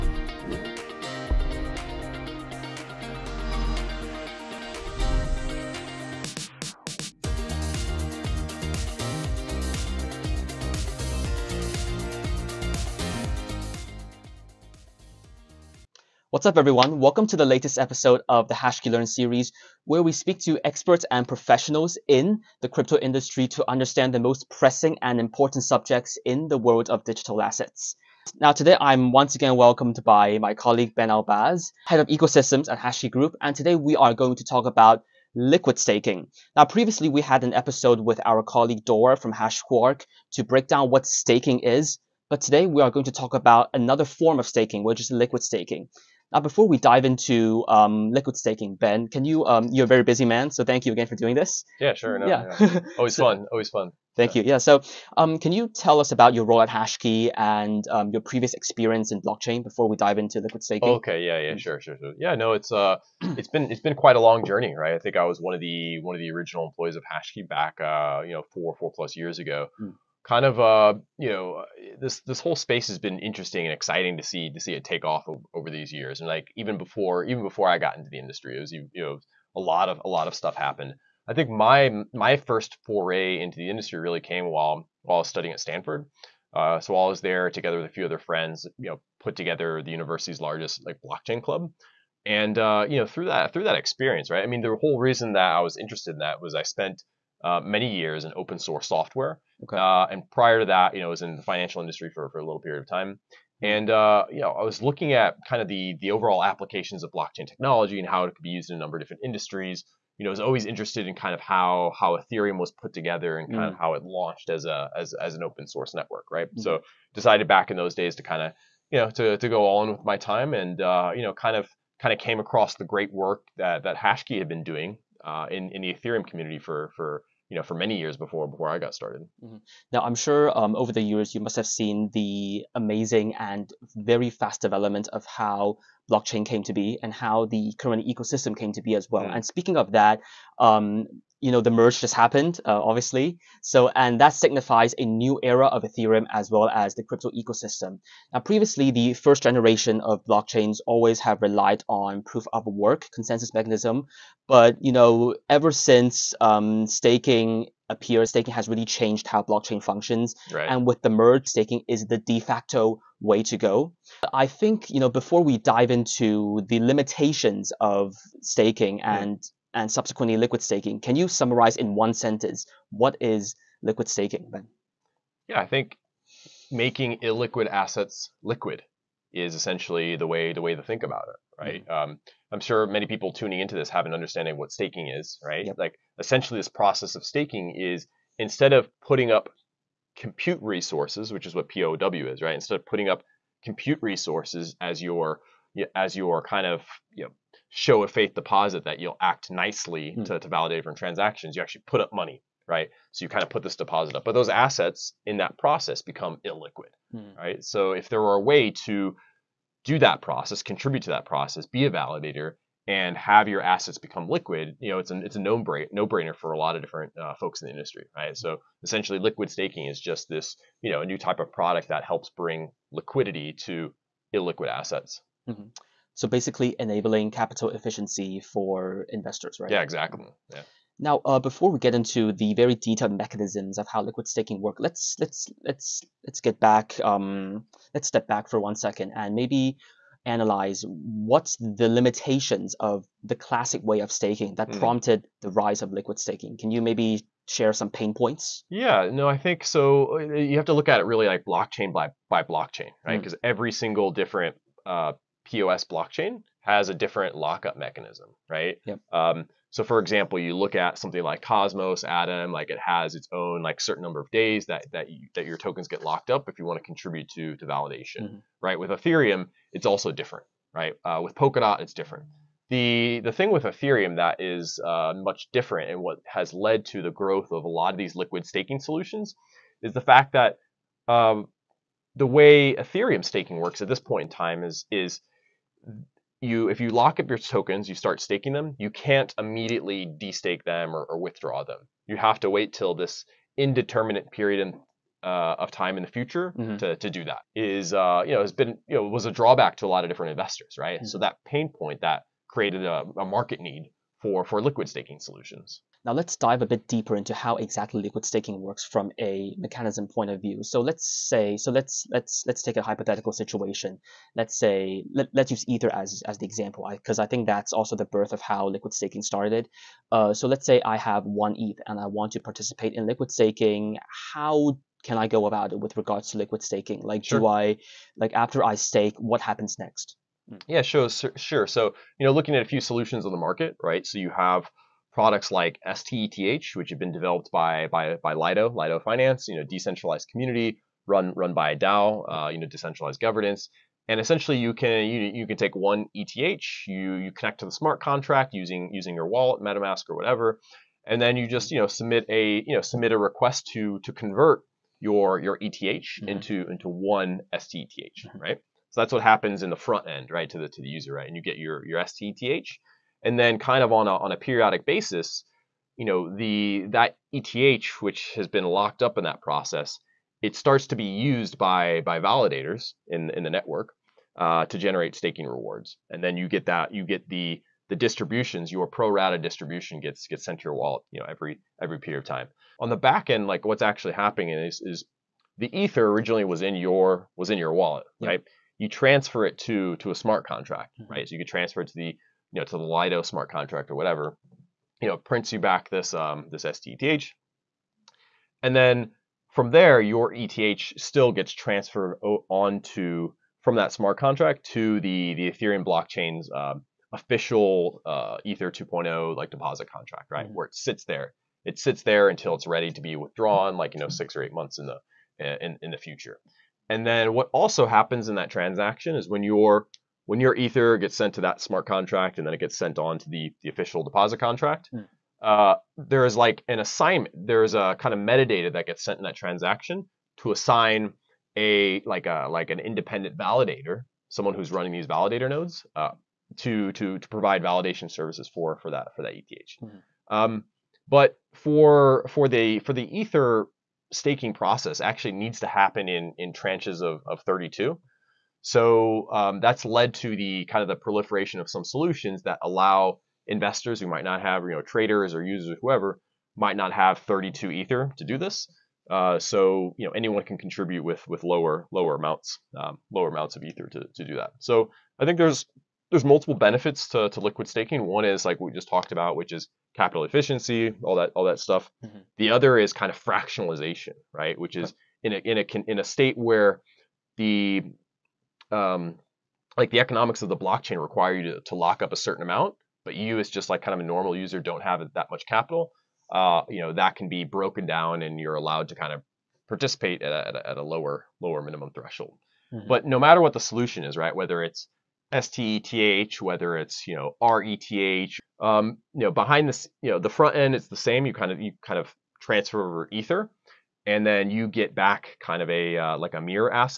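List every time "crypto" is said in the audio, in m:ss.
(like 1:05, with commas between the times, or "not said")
0:22, 2:27.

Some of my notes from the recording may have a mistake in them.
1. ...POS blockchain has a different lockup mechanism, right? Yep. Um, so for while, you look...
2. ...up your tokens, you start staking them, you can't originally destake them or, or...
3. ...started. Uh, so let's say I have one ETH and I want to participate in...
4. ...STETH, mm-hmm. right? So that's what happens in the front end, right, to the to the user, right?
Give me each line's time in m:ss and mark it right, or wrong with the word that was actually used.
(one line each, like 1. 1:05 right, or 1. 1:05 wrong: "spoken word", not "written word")
1. 4:15 wrong: "example", not "while"
2. 4:47 wrong: "immediately", not "originally"
3. 5:19 right
4. 5:57 right.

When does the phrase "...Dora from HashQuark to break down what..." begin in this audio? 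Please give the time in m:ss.
0:38.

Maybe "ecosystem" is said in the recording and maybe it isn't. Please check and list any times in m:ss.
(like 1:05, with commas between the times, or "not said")
0:32, 2:18, 2:27.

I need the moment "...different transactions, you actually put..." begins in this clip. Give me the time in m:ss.
3:20.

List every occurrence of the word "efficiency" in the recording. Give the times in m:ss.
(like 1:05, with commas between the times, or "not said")
3:47, 7:50.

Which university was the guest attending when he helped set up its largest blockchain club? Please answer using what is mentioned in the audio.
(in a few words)
Stanford.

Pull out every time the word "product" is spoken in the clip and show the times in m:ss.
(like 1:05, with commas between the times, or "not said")
3:41, 5:35.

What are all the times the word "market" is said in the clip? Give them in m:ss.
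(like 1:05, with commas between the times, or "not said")
5:03, 5:33.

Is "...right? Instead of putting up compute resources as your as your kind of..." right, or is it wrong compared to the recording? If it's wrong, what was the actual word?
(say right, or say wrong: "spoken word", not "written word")
right.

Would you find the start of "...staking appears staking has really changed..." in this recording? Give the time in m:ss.
2:36.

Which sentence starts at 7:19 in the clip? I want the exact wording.
mm Um, but for for the for the ether staking process actually needs to happen in, in tranches of, of 32.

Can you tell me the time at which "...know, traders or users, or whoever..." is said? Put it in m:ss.
7:34.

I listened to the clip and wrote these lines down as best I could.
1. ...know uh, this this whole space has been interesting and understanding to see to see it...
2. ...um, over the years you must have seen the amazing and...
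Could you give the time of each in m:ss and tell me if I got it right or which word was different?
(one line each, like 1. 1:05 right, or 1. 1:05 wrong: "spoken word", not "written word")
1. 1:11 wrong: "exciting", not "understanding"
2. 2:10 right.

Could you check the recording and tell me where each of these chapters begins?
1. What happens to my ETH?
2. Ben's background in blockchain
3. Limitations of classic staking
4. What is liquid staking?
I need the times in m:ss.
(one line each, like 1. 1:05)
1. 5:06
2. 0:54
3. 3:52
4. 2:50.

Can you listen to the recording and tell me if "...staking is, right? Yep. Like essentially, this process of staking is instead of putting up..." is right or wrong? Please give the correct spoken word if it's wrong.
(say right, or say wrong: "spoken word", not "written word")
right.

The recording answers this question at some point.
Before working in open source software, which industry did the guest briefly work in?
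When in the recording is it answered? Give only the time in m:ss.
1:41.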